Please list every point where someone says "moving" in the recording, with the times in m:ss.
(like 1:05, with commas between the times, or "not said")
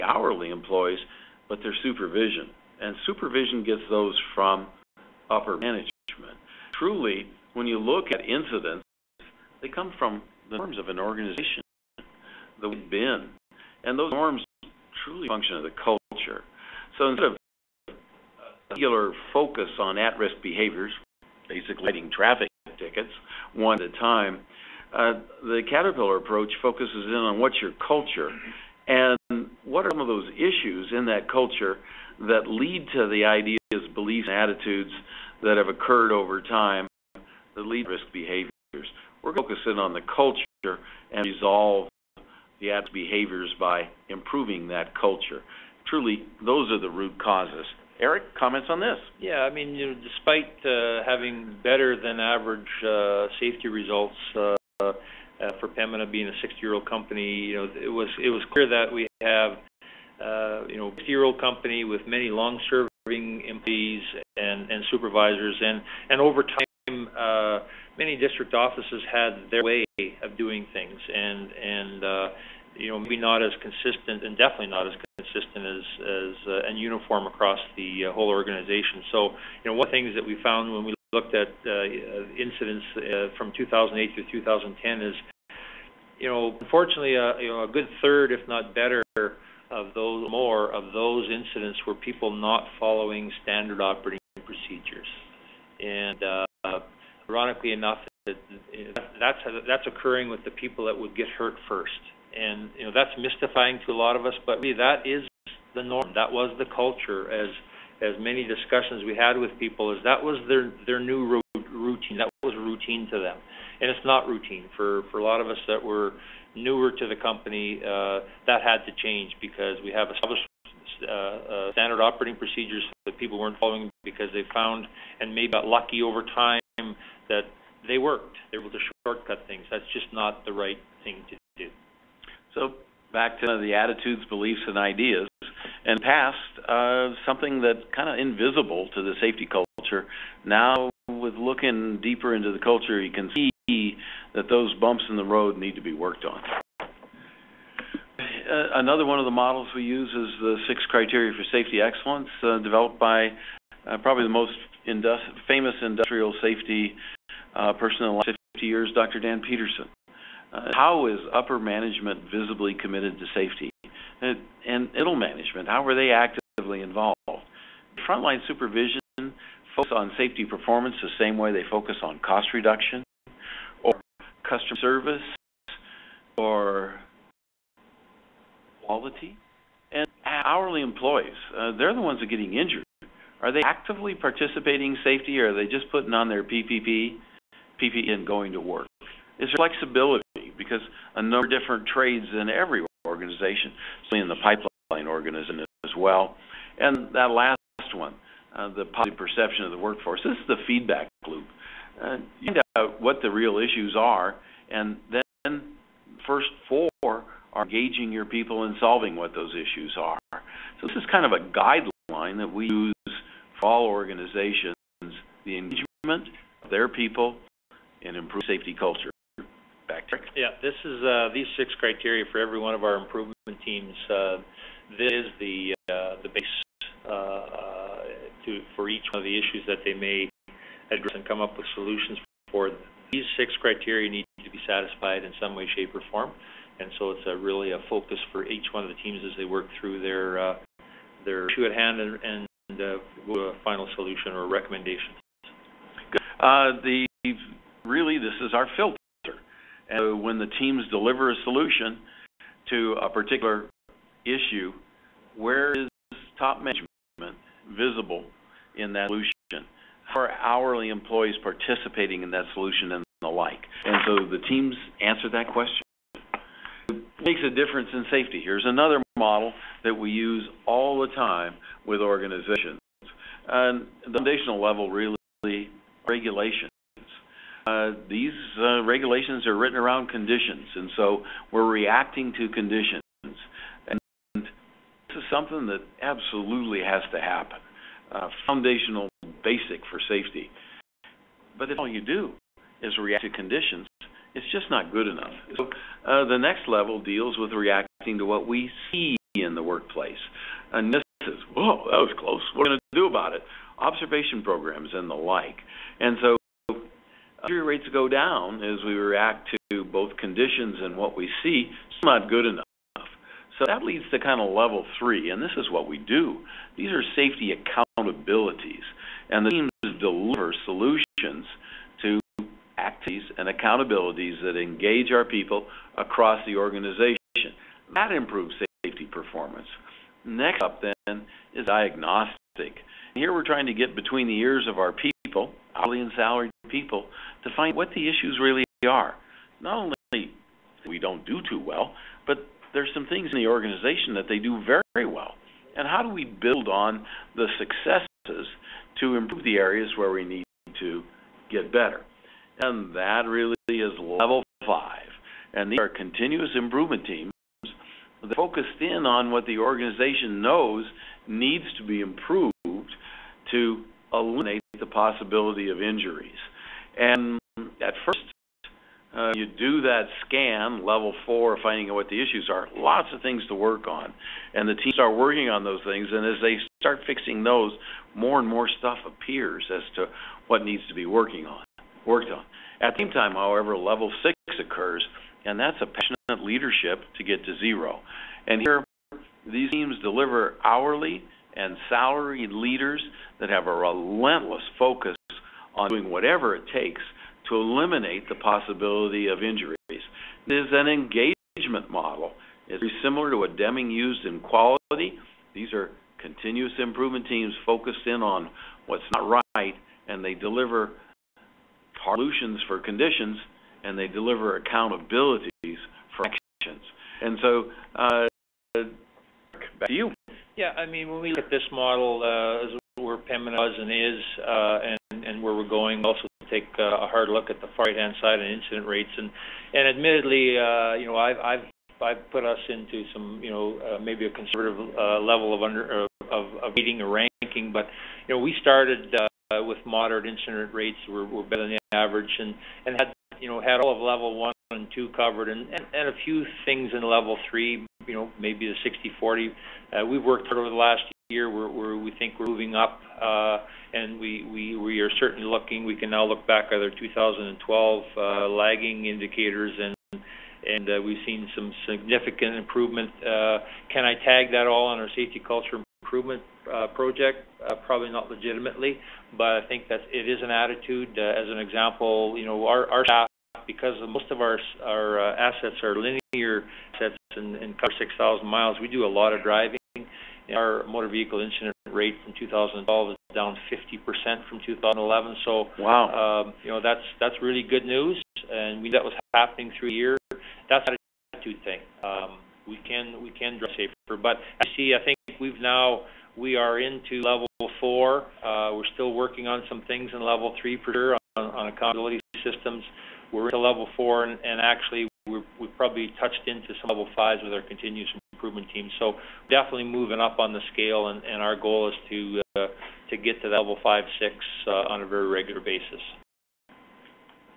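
7:32, 8:29.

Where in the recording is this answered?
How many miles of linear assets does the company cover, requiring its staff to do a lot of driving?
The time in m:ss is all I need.
7:57.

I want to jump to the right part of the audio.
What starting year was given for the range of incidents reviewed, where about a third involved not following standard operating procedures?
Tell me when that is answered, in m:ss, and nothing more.
1:23.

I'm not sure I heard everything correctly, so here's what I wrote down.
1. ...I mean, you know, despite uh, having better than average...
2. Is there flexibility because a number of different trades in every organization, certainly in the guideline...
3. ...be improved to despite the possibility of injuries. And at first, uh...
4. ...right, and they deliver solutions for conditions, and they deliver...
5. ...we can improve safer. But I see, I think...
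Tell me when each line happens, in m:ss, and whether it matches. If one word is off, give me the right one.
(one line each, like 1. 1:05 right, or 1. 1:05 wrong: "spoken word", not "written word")
1. 0:49 right
2. 3:09 wrong: "pipeline", not "guideline"
3. 6:01 wrong: "eliminate", not "despite"
4. 6:49 right
5. 8:13 wrong: "drive", not "improve".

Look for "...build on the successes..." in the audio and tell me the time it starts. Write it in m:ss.
5:46.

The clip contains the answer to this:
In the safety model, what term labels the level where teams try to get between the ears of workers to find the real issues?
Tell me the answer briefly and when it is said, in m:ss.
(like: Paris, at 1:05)
diagnostic, at 5:31.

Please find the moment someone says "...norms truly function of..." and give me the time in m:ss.
0:14.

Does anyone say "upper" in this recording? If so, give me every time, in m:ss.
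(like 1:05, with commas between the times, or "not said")
0:05, 2:41.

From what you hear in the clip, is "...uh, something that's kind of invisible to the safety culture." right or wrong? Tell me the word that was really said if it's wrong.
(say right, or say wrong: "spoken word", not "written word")
right.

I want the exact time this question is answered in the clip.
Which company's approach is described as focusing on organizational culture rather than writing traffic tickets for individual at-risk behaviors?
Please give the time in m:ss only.
0:25.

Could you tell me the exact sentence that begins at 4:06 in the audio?
the really this is our filter.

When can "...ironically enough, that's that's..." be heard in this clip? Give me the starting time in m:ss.
1:37.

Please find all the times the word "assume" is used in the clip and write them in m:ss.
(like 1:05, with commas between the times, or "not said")
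not said.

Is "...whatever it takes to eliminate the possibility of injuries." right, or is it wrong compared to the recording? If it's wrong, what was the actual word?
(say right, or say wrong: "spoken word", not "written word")
right.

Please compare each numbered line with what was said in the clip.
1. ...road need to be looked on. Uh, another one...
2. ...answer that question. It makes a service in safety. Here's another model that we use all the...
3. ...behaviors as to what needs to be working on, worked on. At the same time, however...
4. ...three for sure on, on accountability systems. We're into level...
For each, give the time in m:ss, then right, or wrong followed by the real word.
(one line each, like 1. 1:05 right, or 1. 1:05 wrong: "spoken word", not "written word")
1. 2:25 wrong: "worked", not "looked"
2. 4:25 wrong: "difference", not "service"
3. 6:19 wrong: "appears", not "behaviors"
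4. 8:20 right.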